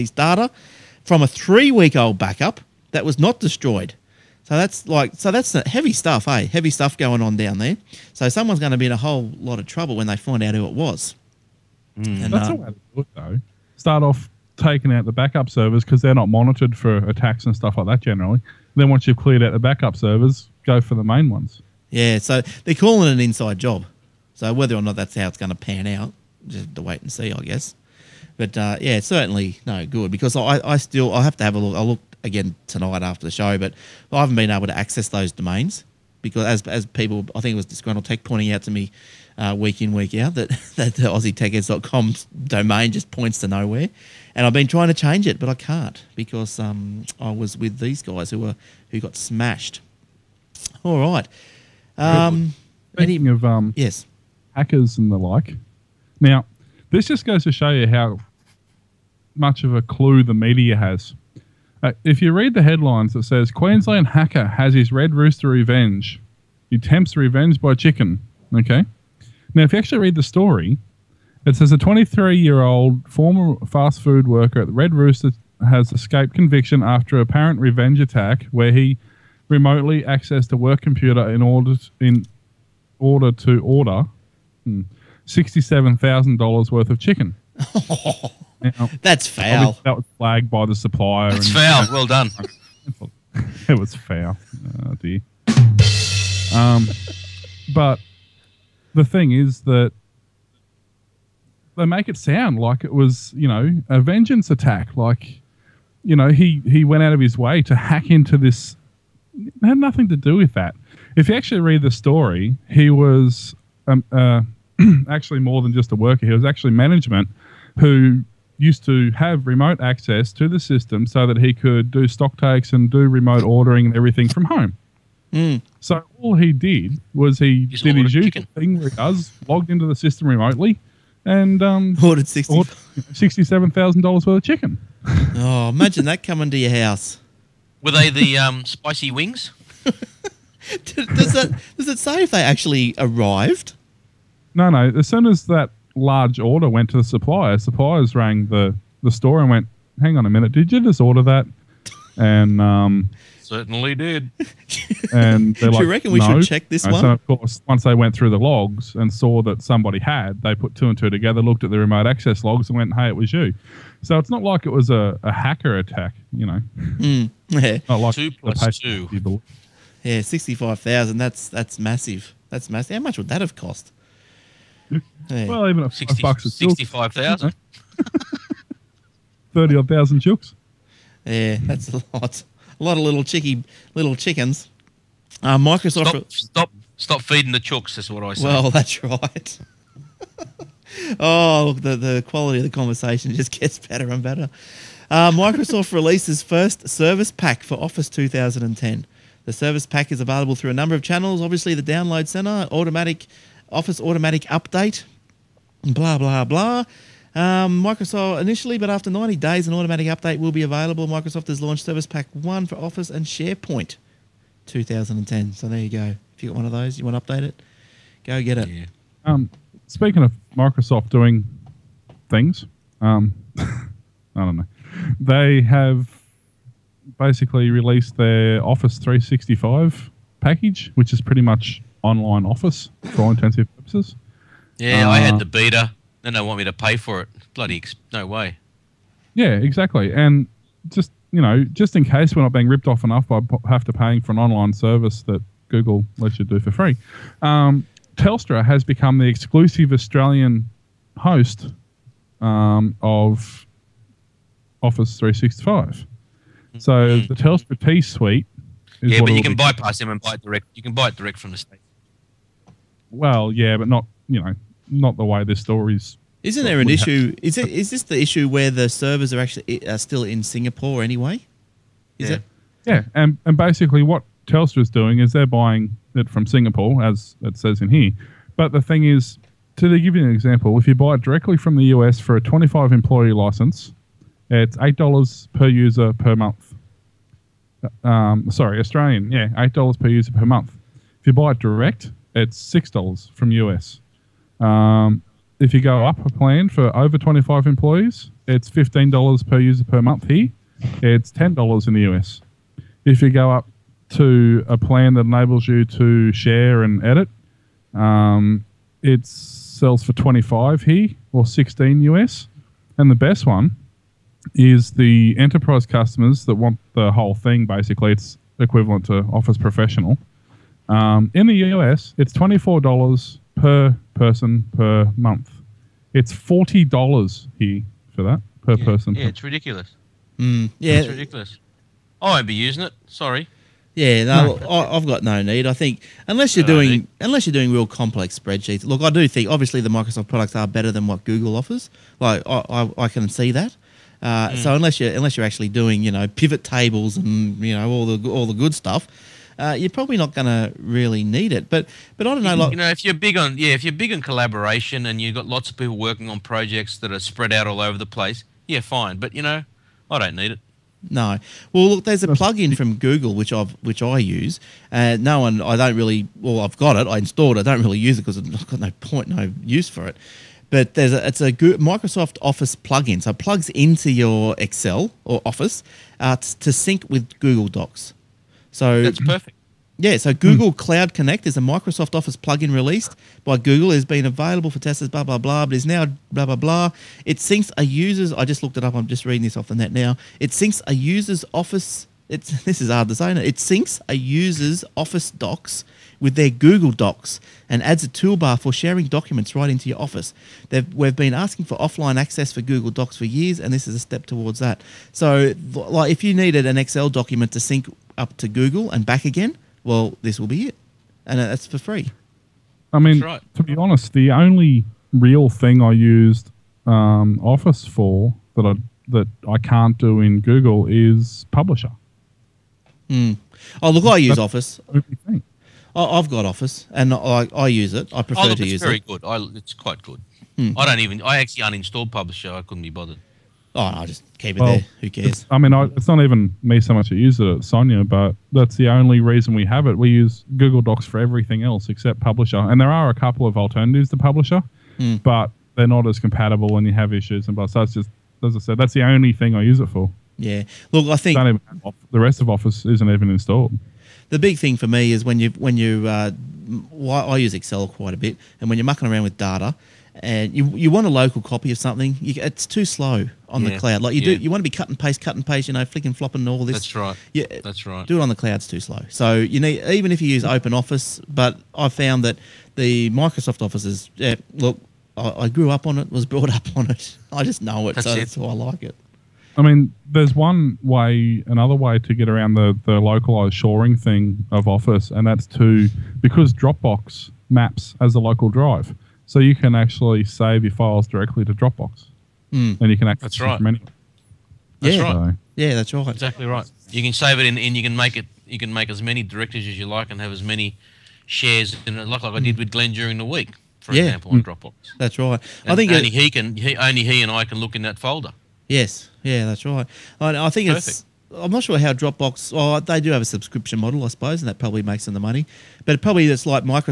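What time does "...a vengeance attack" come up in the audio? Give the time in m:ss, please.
1:43.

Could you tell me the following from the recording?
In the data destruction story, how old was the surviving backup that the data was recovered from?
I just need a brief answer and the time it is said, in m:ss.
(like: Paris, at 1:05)
3 weeks, at 0:01.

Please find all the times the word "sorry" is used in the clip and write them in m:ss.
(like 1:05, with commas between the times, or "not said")
4:48, 5:33.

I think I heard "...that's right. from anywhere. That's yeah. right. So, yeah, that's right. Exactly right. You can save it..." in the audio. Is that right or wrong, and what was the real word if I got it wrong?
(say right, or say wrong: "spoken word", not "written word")
right.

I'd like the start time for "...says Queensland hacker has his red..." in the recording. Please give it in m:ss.
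1:03.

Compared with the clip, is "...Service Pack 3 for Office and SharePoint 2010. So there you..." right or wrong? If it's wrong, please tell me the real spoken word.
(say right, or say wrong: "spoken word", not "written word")
wrong: "1", not "3".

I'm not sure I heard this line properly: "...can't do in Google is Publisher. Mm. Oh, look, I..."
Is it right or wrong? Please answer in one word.
right.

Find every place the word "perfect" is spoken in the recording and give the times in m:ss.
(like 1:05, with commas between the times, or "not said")
6:19, 8:30.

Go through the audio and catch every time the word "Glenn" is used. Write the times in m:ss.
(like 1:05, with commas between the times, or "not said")
8:22.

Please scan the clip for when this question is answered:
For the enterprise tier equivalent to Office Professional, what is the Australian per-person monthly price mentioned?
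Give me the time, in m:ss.
5:26.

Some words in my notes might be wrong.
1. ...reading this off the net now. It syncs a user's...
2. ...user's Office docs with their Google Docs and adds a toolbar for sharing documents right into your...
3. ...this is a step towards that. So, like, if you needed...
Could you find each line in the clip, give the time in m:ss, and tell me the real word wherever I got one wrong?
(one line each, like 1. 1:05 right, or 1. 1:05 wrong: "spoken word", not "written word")
1. 6:29 right
2. 6:34 right
3. 6:43 right.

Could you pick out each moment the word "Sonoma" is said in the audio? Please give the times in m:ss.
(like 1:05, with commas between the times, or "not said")
not said.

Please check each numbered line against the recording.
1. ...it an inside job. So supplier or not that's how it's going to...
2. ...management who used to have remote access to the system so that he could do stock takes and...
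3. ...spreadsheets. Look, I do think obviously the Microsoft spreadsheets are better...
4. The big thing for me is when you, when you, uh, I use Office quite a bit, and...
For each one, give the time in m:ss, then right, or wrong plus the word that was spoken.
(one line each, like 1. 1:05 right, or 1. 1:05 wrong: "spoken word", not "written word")
1. 0:23 wrong: "whether", not "supplier"
2. 1:56 right
3. 5:38 wrong: "products", not "spreadsheets"
4. 7:34 wrong: "Excel", not "Office".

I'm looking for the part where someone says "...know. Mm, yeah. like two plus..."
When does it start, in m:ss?
2:46.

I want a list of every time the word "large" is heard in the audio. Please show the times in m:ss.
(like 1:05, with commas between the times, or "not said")
2:25.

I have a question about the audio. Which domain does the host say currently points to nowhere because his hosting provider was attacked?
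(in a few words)
AussieTechHeads.com.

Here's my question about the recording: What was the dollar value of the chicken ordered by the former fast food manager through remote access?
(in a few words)
$67,000.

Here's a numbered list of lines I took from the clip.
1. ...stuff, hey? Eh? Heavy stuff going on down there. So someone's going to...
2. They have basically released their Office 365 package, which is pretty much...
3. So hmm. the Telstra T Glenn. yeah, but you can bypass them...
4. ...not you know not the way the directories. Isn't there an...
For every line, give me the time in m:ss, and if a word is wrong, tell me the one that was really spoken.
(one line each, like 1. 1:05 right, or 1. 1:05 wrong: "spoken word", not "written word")
1. 0:05 right
2. 3:45 right
3. 4:16 wrong: "Suite", not "Glenn"
4. 4:23 wrong: "stories", not "directories".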